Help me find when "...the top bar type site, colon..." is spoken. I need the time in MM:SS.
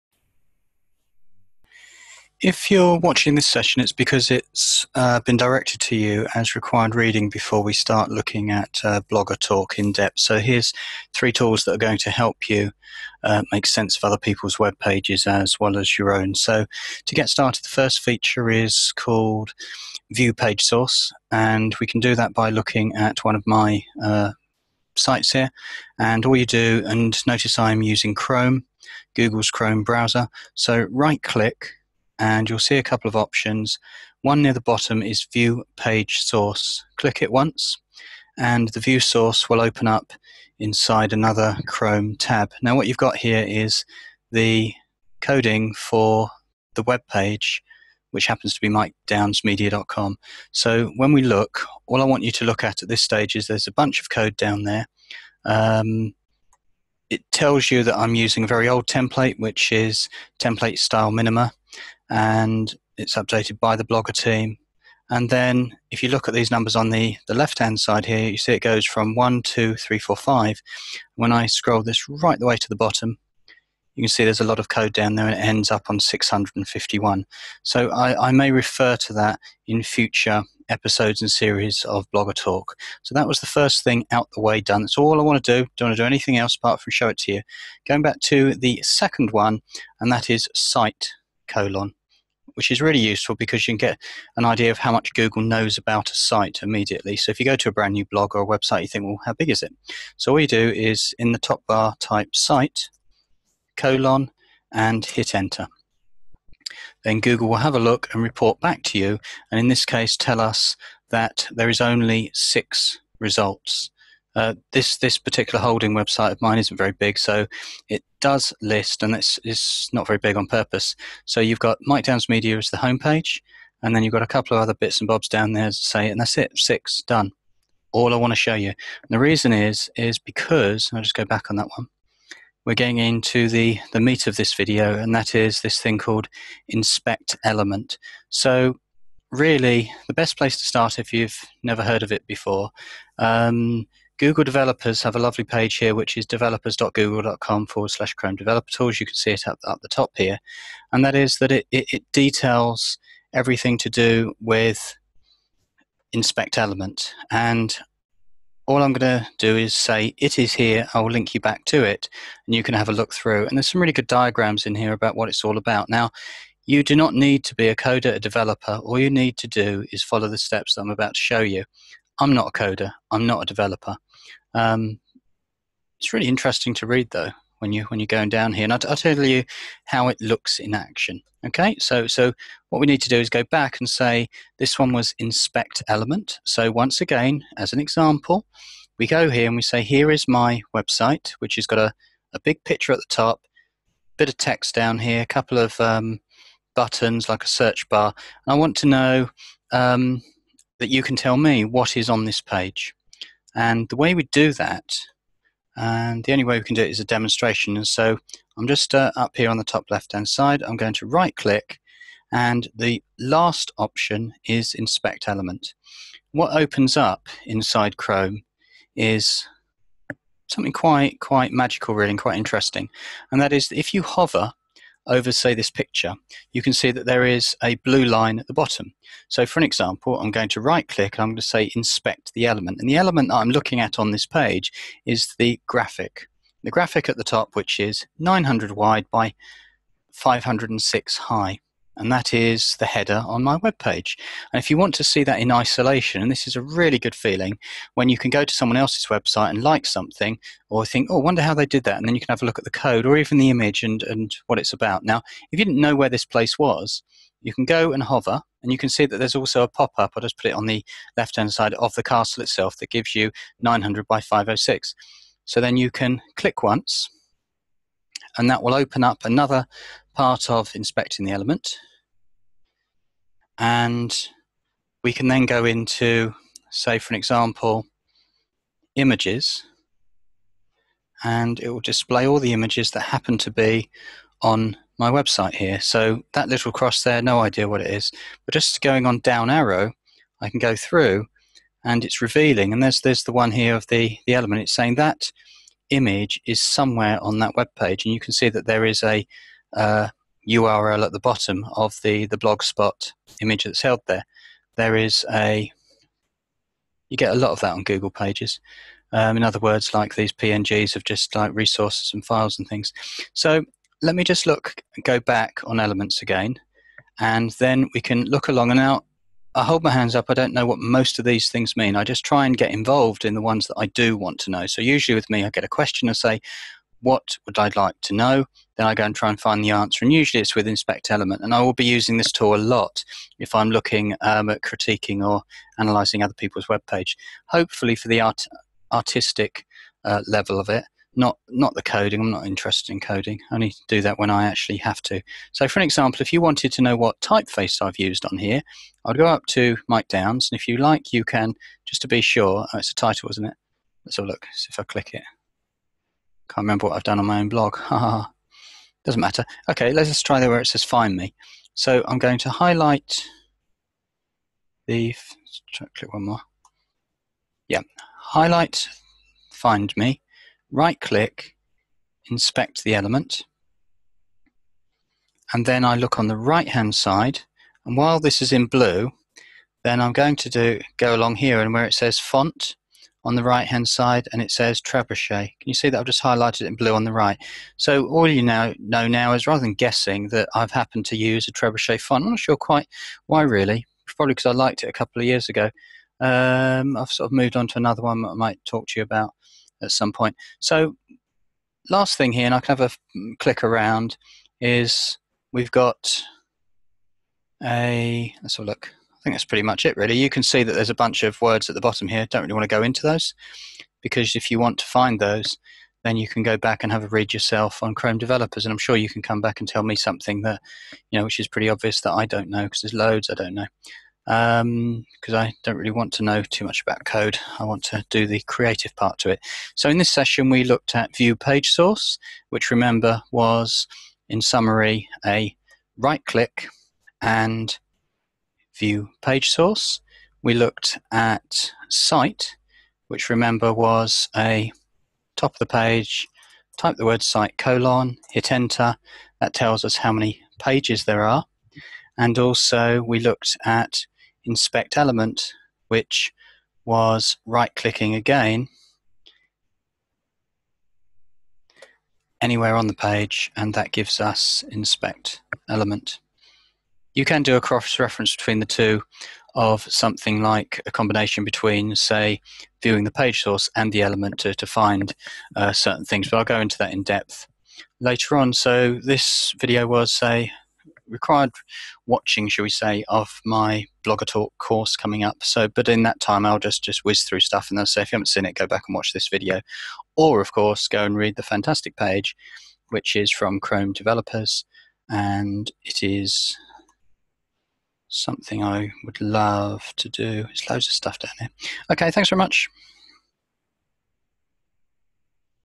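01:41.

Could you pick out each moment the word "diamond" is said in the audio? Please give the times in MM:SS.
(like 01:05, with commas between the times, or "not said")
not said.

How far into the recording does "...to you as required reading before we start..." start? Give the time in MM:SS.
00:05.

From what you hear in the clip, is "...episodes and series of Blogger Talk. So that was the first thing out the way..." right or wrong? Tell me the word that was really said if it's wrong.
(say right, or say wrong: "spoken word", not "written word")
right.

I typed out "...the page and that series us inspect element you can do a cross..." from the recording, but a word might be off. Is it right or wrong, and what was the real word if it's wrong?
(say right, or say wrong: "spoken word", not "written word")
wrong: "gives", not "series".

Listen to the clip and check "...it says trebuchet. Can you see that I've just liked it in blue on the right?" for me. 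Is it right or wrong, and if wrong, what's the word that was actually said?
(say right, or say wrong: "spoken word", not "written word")
wrong: "highlighted", not "liked".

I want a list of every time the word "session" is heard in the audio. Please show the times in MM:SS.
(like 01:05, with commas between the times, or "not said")
00:03, 07:10.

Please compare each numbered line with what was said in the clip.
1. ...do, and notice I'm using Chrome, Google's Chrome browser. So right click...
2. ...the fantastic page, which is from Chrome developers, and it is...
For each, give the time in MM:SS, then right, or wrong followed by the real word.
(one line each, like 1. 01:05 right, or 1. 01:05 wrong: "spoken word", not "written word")
1. 00:26 right
2. 08:11 right.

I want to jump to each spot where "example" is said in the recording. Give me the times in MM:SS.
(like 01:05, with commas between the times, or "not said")
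03:07, 03:49, 04:37, 05:45.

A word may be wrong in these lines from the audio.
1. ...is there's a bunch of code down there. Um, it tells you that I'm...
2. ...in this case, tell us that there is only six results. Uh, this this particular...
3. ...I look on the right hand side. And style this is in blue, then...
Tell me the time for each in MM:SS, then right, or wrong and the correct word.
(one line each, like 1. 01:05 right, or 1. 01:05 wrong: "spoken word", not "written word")
1. 00:53 right
2. 01:49 right
3. 06:15 wrong: "while", not "style".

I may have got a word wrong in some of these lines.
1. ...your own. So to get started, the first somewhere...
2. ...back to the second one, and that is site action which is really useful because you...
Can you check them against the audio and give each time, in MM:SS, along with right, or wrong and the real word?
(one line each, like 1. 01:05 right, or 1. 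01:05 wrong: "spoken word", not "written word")
1. 00:15 wrong: "feature", not "somewhere"
2. 01:28 wrong: "colon", not "action".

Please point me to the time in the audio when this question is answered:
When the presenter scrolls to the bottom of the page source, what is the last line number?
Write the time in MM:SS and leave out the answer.
01:15.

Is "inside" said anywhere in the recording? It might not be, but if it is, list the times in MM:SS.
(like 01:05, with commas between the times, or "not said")
00:40, 03:37.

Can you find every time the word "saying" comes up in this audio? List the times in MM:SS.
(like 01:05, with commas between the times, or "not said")
04:54.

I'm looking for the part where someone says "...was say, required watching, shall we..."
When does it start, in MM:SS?
07:59.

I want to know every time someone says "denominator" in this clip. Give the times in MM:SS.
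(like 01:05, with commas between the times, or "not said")
not said.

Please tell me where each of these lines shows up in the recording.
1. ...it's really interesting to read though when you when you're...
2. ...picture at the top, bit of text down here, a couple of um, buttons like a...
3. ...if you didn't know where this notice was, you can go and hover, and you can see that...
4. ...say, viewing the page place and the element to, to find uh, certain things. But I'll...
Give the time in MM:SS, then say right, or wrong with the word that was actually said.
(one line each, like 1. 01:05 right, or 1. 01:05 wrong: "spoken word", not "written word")
1. 02:55 right
2. 03:12 right
3. 04:15 wrong: "place", not "notice"
4. 07:51 wrong: "source", not "place".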